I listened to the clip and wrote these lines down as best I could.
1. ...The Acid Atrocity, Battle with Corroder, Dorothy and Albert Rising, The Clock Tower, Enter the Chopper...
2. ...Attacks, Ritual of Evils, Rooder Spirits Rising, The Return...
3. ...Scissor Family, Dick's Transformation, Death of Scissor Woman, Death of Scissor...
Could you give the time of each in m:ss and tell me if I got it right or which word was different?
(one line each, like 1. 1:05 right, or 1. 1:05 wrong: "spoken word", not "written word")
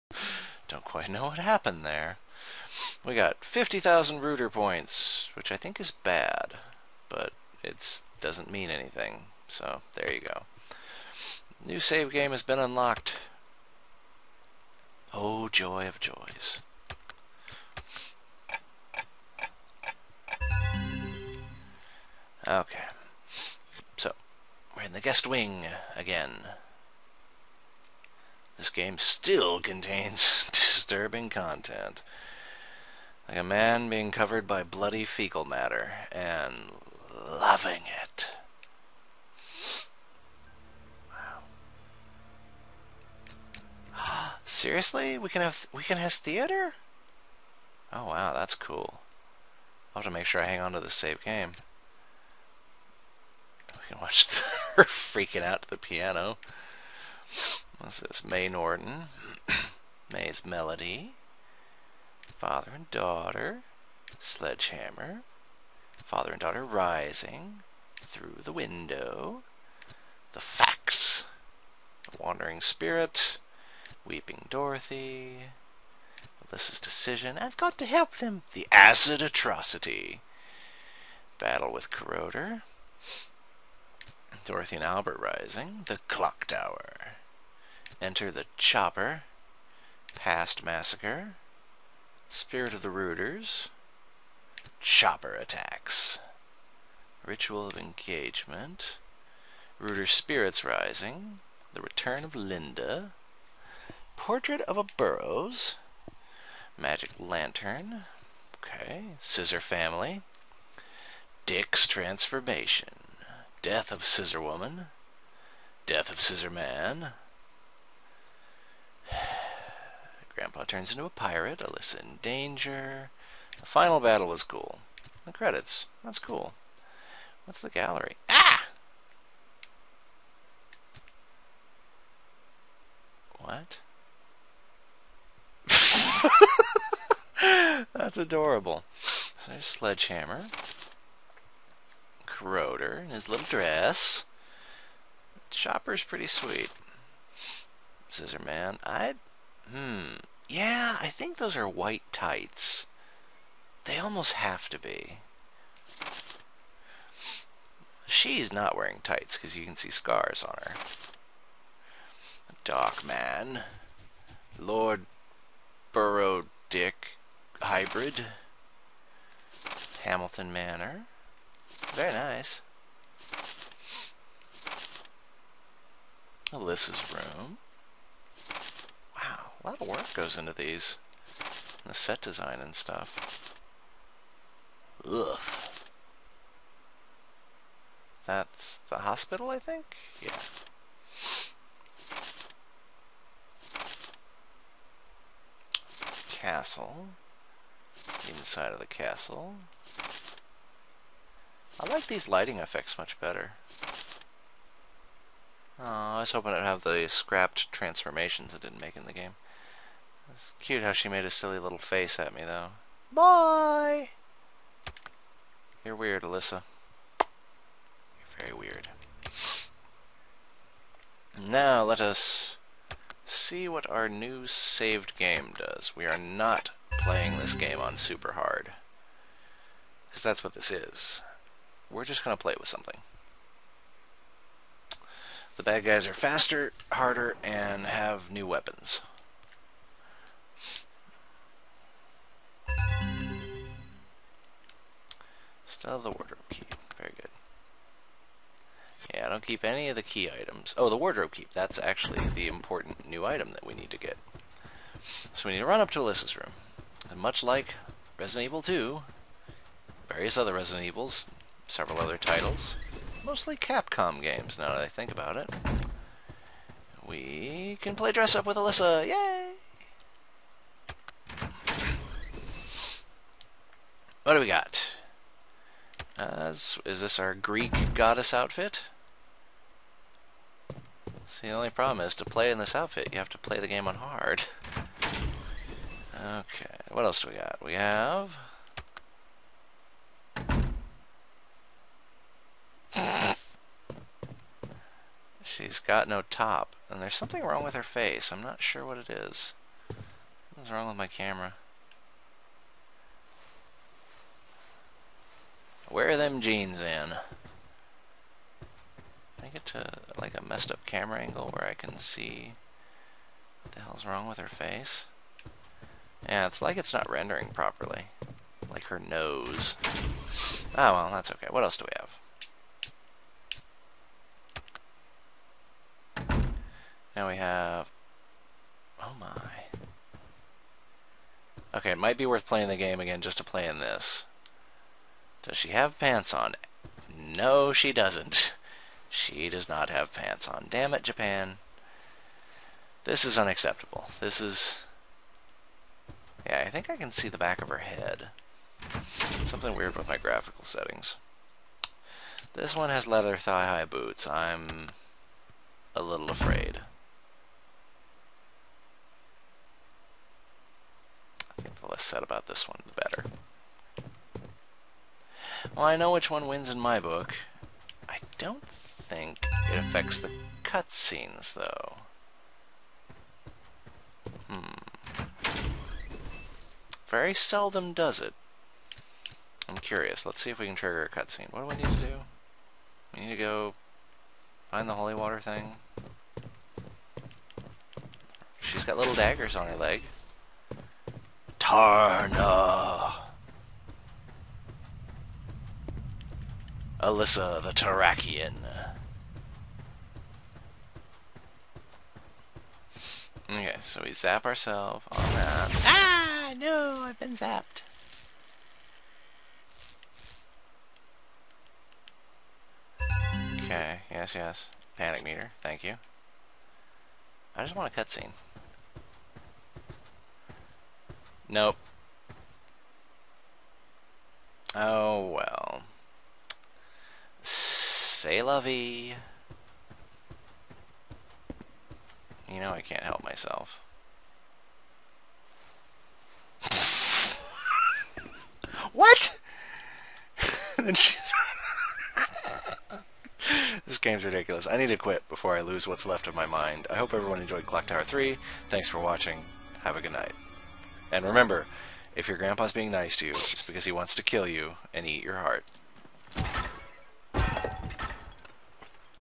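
1. 1:18 right
2. 1:35 wrong: "Engagement", not "Evils"
3. 1:49 right.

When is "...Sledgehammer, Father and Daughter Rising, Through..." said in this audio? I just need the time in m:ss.
1:04.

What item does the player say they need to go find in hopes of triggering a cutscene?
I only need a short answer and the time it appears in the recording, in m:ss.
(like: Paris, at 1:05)
The holy water thing, at 6:24.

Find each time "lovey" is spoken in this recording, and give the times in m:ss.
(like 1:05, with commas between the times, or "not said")
7:08.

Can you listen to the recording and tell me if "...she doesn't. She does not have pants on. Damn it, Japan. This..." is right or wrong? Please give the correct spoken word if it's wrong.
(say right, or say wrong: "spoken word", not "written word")
right.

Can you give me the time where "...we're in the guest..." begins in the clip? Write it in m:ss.
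0:24.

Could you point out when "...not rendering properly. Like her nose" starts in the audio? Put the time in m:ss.
5:16.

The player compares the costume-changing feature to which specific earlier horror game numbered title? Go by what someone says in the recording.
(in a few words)
Resident Evil 2.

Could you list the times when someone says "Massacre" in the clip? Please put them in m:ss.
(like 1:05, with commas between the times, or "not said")
1:30.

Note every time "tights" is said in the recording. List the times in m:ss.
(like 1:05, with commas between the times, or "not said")
2:32, 2:39.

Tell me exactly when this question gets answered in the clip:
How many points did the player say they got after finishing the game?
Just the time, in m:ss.
0:03.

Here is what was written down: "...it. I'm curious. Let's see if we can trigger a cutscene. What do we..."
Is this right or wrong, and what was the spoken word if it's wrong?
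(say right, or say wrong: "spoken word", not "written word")
right.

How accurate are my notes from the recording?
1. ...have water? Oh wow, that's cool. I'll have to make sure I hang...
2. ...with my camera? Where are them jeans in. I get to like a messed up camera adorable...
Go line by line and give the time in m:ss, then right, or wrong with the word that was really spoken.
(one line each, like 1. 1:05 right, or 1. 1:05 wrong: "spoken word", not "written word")
1. 0:45 wrong: "theater", not "water"
2. 5:00 wrong: "angle", not "adorable".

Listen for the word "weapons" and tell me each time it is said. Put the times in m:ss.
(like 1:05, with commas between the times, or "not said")
3:58.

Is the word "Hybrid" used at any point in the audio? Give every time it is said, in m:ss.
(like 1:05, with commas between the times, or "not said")
2:47.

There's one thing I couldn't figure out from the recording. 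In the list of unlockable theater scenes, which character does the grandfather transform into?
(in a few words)
A pirate.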